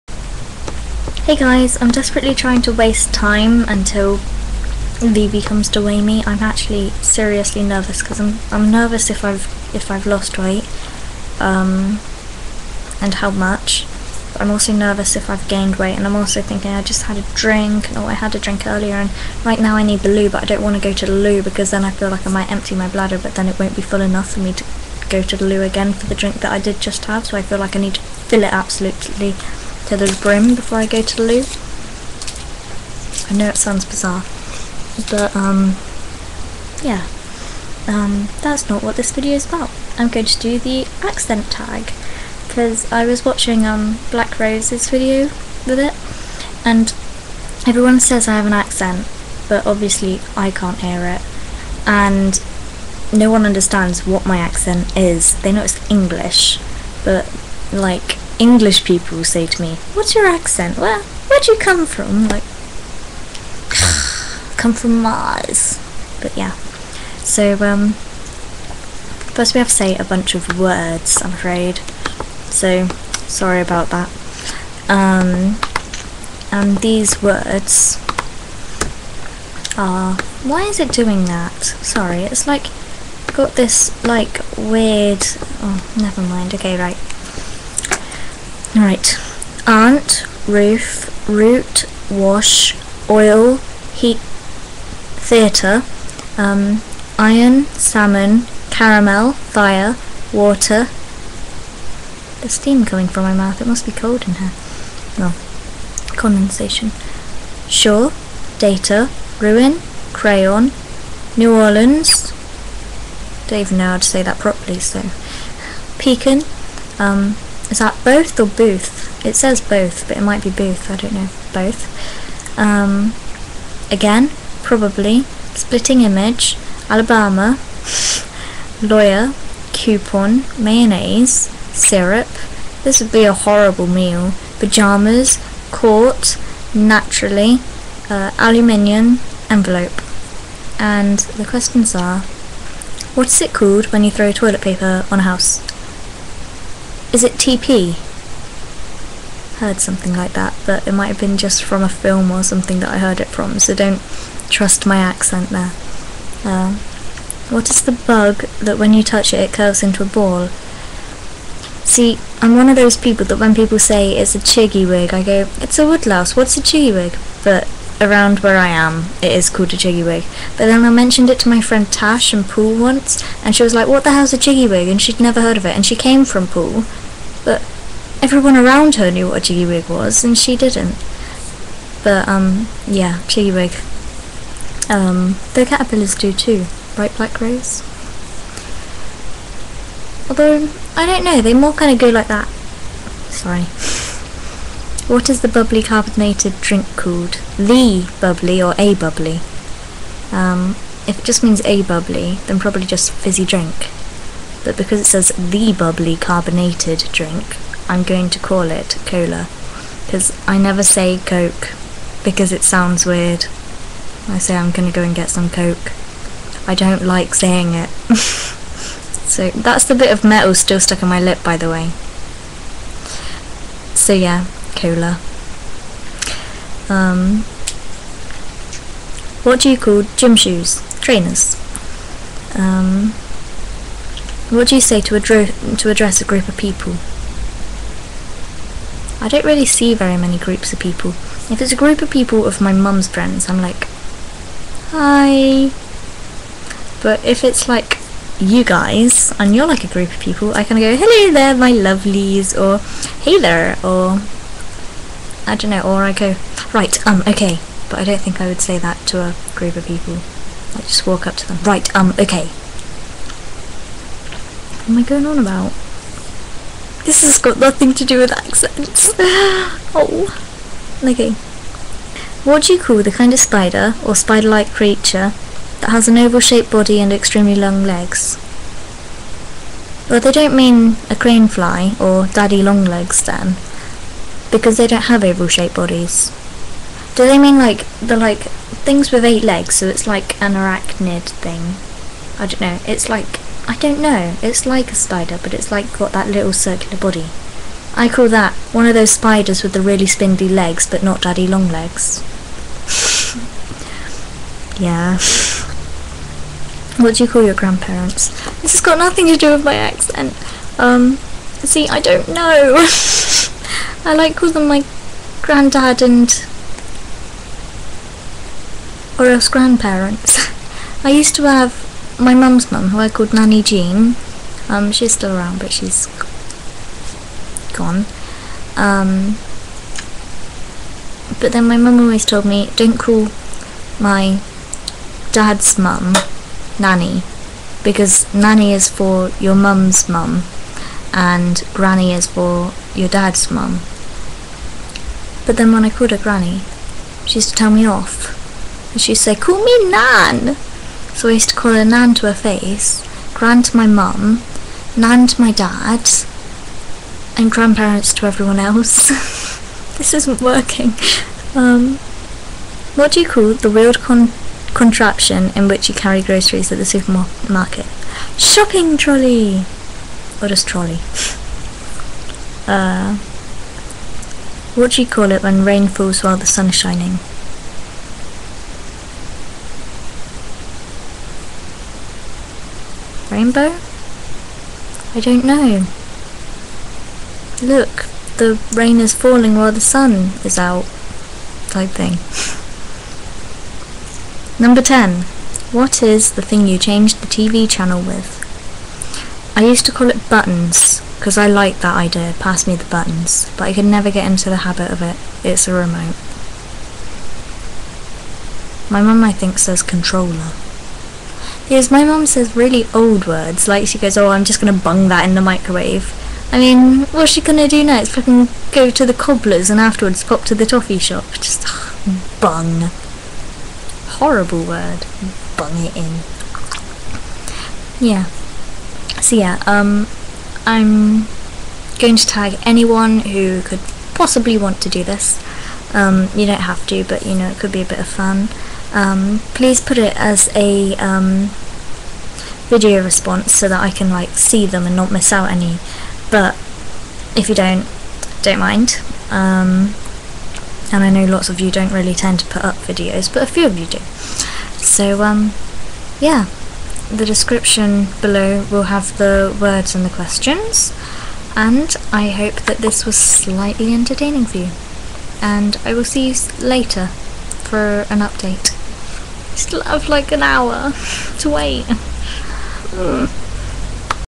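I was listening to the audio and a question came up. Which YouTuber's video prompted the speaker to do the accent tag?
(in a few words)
Black Rose.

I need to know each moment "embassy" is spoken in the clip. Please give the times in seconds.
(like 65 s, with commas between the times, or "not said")
not said.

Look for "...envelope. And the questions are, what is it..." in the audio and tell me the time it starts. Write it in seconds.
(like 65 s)
139 s.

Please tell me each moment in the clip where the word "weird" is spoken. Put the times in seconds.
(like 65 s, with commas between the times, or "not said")
84 s, 213 s, 363 s.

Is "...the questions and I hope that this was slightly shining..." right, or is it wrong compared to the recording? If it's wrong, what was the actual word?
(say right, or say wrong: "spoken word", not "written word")
wrong: "entertaining", not "shining".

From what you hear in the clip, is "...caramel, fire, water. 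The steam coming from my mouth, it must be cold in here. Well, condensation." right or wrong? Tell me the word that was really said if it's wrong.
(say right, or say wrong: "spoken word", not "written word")
right.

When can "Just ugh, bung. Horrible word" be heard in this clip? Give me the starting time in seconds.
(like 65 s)
421 s.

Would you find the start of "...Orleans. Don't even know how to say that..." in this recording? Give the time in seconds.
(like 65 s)
111 s.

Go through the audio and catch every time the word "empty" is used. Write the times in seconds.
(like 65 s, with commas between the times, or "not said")
22 s.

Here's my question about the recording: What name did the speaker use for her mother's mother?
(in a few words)
Nanny Jean.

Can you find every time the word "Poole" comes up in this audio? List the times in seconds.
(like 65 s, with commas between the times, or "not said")
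172 s, 176 s.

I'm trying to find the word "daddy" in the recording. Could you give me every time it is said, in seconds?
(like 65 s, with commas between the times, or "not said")
282 s, 301 s.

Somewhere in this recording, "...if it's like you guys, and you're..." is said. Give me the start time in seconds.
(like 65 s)
247 s.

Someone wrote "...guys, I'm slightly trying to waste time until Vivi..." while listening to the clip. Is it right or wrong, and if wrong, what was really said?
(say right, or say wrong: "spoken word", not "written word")
wrong: "desperately", not "slightly".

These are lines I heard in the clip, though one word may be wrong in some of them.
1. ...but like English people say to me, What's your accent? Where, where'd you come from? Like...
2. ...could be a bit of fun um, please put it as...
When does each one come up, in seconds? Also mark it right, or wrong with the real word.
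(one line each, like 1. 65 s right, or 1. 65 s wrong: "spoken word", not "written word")
1. 57 s right
2. 437 s right.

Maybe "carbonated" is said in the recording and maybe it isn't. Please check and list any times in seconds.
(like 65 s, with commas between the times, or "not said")
195 s, 206 s.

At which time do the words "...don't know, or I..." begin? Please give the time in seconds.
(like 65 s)
255 s.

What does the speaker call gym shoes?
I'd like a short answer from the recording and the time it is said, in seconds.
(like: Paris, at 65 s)
Trainers, at 231 s.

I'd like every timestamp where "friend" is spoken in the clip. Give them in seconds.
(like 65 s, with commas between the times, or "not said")
171 s, 243 s.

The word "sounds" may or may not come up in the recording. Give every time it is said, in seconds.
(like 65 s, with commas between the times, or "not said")
33 s, 212 s.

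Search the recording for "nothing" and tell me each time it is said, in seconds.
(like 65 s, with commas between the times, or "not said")
267 s, 308 s.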